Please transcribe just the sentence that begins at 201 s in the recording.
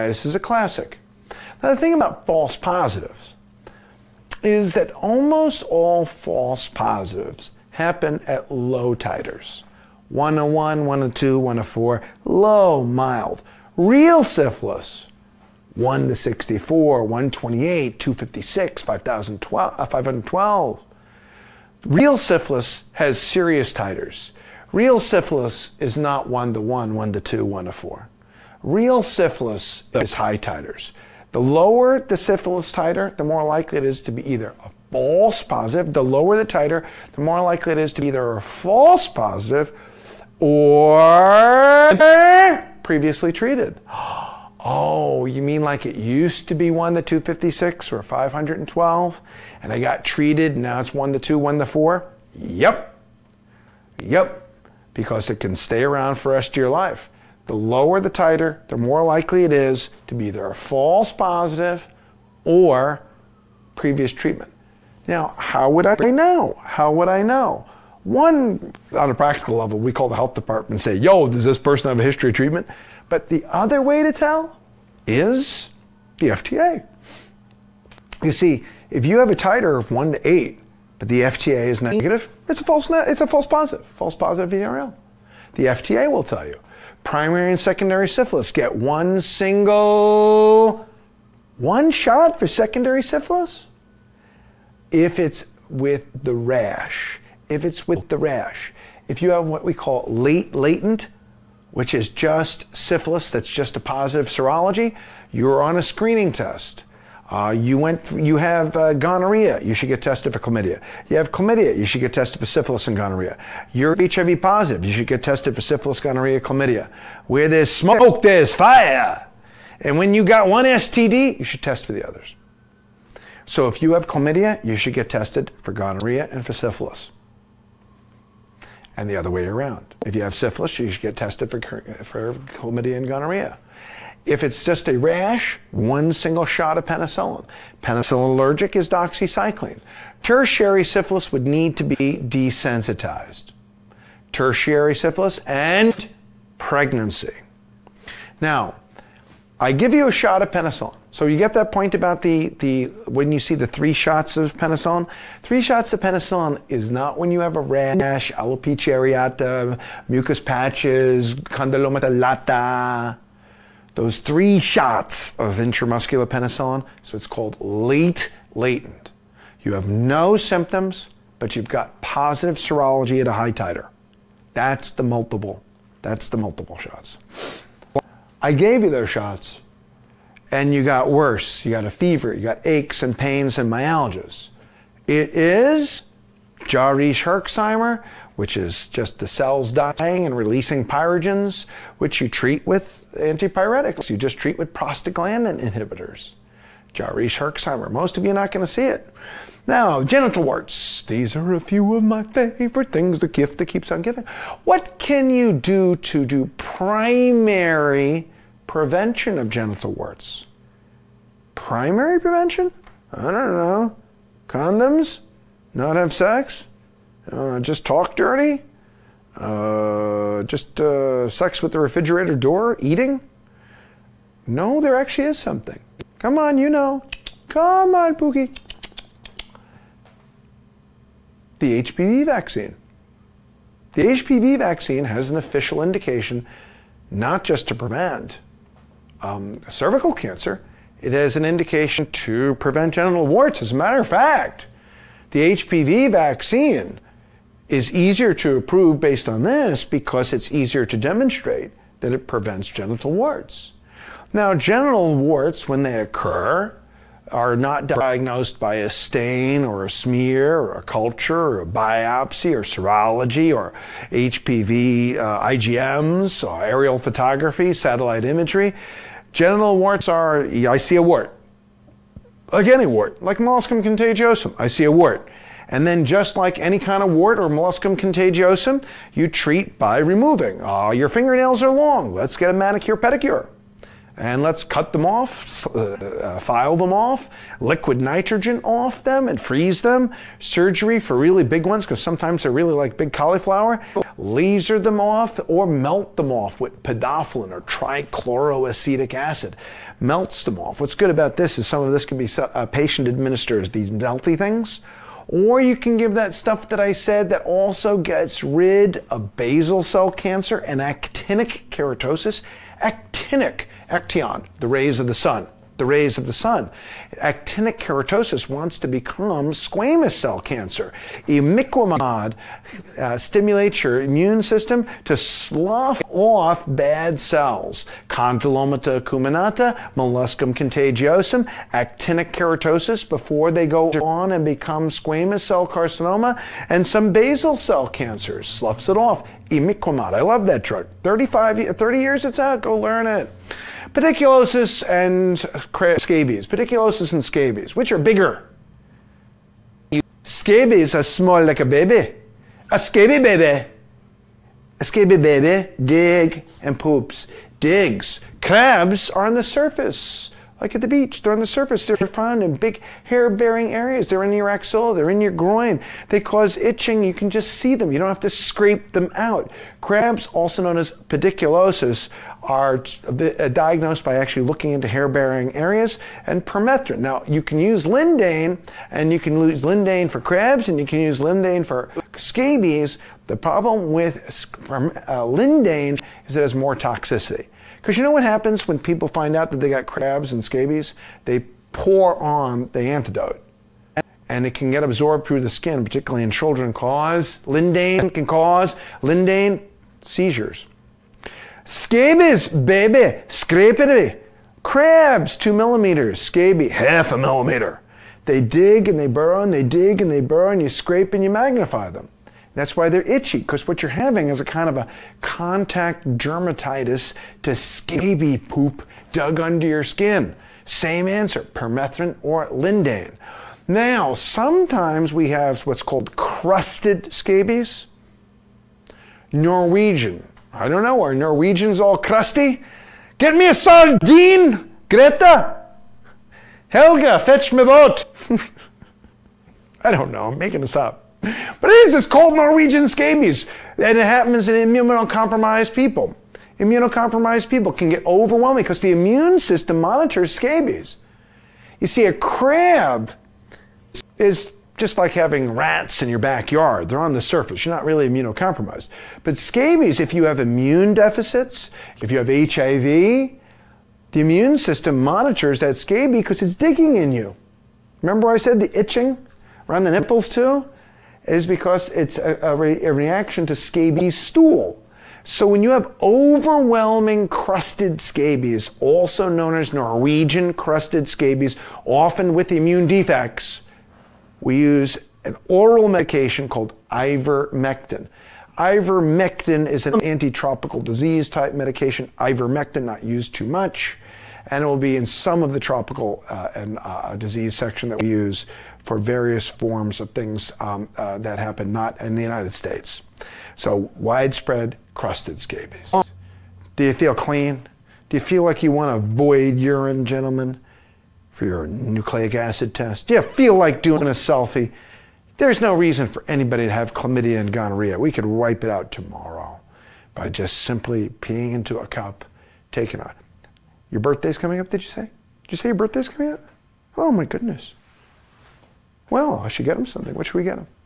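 These are a few of my favorite things, the gift that keeps on giving.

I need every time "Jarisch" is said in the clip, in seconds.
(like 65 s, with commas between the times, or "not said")
186 s, 196 s.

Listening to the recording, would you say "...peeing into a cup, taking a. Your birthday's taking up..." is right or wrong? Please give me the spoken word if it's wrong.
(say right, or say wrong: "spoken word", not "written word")
wrong: "coming", not "taking".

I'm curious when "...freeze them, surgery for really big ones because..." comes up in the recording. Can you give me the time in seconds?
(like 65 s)
289 s.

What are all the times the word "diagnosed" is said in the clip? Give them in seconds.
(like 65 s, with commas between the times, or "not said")
257 s, 373 s.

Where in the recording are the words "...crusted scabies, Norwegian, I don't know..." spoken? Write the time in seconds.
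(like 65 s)
426 s.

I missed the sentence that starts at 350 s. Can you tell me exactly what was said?
Scabies are small like a baby.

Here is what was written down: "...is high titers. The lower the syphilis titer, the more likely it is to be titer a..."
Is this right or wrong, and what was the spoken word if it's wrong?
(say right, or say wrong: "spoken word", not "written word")
wrong: "either", not "titer".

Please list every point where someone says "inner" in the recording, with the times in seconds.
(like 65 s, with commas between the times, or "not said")
not said.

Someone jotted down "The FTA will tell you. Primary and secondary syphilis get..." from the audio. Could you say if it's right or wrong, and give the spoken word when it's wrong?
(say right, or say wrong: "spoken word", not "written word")
right.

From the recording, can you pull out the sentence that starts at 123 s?
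So if you have chlamydia, you should get tested for gonorrhea and for syphilis and the other way around.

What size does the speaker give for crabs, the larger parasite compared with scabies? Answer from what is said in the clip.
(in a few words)
2 millimeters.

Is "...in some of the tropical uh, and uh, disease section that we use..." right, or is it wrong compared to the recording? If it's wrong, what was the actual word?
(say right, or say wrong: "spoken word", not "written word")
right.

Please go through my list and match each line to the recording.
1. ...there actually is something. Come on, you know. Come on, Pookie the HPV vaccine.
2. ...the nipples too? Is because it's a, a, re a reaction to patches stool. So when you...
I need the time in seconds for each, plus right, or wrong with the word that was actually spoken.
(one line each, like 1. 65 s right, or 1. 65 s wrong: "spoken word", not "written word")
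1. 224 s right
2. 469 s wrong: "scabies", not "patches".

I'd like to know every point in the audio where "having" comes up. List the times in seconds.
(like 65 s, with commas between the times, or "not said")
413 s, 455 s.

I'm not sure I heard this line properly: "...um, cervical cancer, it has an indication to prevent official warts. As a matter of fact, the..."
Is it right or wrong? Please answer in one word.
wrong.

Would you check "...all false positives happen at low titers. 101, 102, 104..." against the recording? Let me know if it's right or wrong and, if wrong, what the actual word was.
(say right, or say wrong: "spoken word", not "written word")
right.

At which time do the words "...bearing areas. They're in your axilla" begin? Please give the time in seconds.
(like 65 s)
363 s.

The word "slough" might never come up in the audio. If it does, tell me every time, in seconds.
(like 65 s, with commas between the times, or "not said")
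325 s, 338 s.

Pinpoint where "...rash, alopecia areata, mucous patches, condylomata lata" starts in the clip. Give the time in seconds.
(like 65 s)
157 s.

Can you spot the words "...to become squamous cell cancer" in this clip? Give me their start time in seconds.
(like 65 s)
318 s.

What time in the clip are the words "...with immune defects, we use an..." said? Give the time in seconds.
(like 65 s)
482 s.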